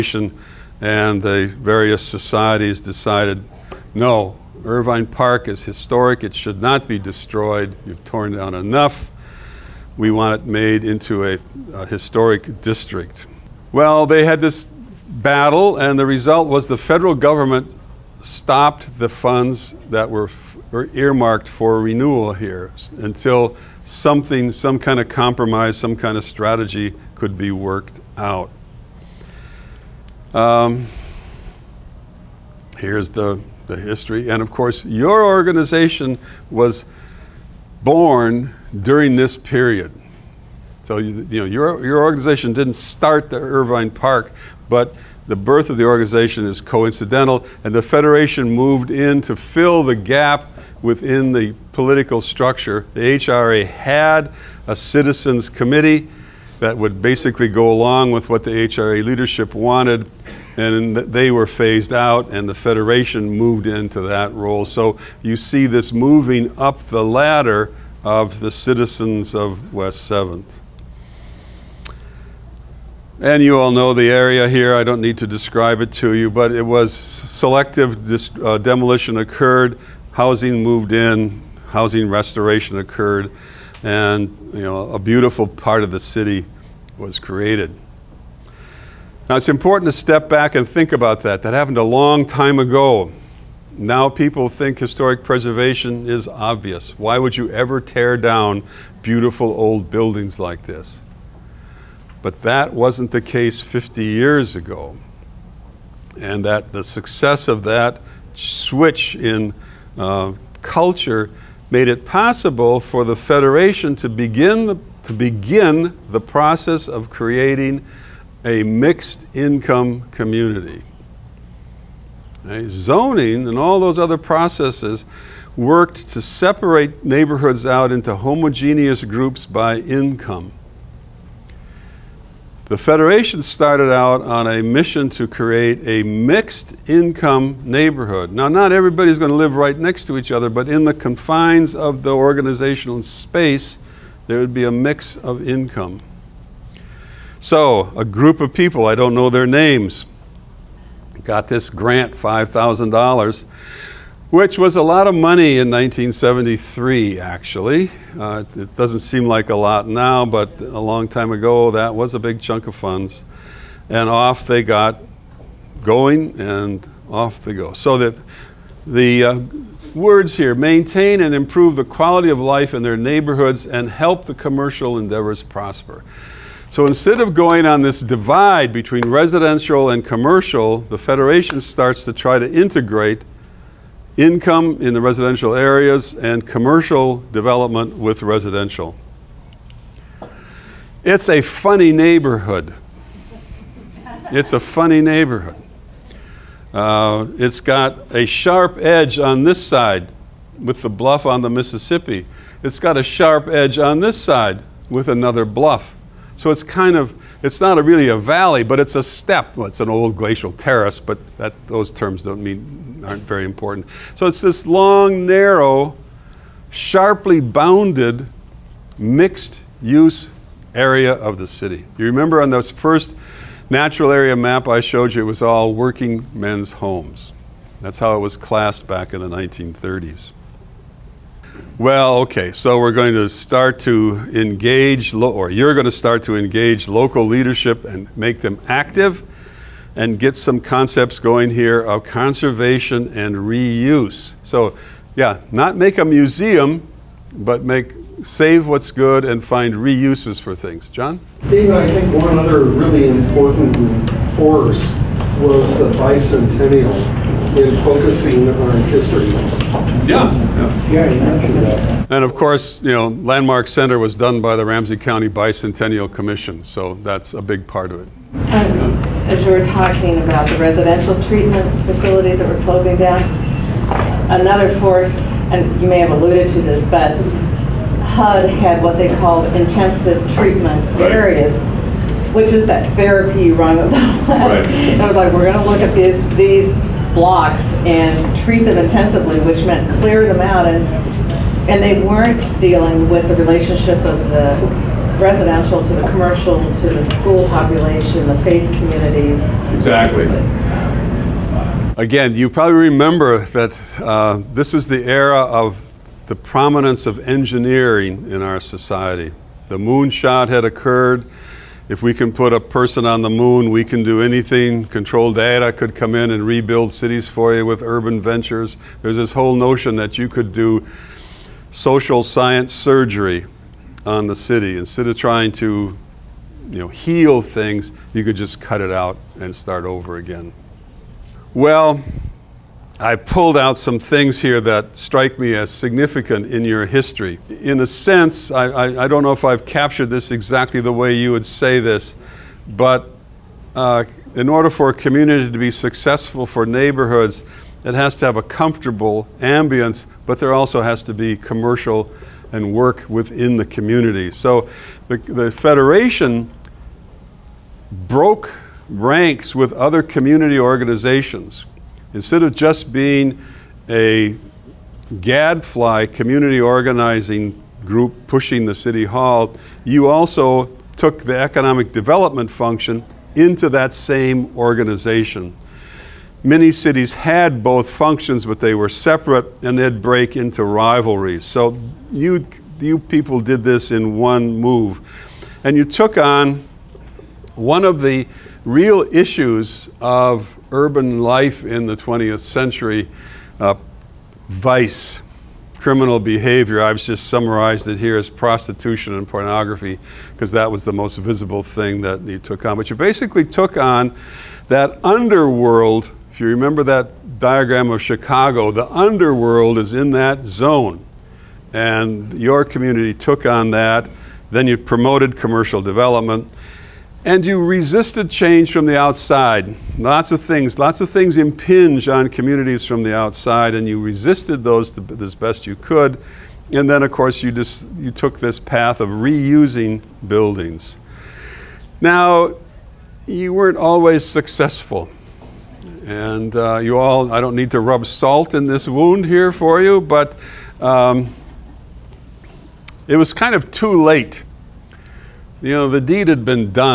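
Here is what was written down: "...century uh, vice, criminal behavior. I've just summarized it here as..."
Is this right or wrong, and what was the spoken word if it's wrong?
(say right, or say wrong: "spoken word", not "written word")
right.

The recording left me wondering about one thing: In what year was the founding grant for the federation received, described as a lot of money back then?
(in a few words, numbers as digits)
1973.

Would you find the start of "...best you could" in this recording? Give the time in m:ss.
7:05.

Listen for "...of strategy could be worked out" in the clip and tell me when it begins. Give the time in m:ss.
0:26.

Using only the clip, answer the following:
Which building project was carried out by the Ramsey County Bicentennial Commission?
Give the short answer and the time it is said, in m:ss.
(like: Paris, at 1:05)
Landmark Center, at 4:23.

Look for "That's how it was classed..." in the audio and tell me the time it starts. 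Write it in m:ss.
3:47.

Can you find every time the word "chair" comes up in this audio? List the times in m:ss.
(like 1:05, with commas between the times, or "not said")
not said.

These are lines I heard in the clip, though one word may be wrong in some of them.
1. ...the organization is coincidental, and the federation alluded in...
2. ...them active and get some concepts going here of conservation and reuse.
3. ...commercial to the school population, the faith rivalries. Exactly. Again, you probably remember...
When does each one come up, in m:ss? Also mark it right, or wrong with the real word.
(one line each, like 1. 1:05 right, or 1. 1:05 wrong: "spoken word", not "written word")
1. 0:45 wrong: "moved", not "alluded"
2. 3:58 right
3. 4:56 wrong: "communities", not "rivalries".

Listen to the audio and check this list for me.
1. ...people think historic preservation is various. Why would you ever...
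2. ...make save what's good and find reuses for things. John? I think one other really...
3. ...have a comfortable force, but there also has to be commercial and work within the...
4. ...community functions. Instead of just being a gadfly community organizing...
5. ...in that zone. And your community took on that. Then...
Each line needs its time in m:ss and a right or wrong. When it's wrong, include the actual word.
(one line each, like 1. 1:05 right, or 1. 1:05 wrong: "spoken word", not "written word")
1. 1:34 wrong: "obvious", not "various"
2. 4:07 right
3. 5:48 wrong: "ambience", not "force"
4. 6:00 wrong: "organizations", not "functions"
5. 6:49 right.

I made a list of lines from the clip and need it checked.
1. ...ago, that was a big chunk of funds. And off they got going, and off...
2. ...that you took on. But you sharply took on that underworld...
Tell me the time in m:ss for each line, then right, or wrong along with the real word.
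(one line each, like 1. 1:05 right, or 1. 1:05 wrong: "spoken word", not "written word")
1. 2:41 right
2. 6:42 wrong: "basically", not "sharply".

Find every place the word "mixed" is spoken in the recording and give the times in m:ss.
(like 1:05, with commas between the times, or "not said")
1:58, 2:16, 3:38.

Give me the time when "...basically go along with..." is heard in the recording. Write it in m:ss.
0:57.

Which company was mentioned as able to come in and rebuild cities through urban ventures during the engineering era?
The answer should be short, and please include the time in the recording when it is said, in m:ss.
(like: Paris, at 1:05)
Control Data, at 5:14.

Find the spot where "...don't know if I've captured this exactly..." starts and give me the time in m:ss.
5:39.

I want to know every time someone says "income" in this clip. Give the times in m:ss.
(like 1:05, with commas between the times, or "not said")
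1:59, 2:09, 2:16, 2:25, 3:04.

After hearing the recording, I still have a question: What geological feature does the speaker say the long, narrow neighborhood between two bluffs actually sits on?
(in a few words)
glacial terrace.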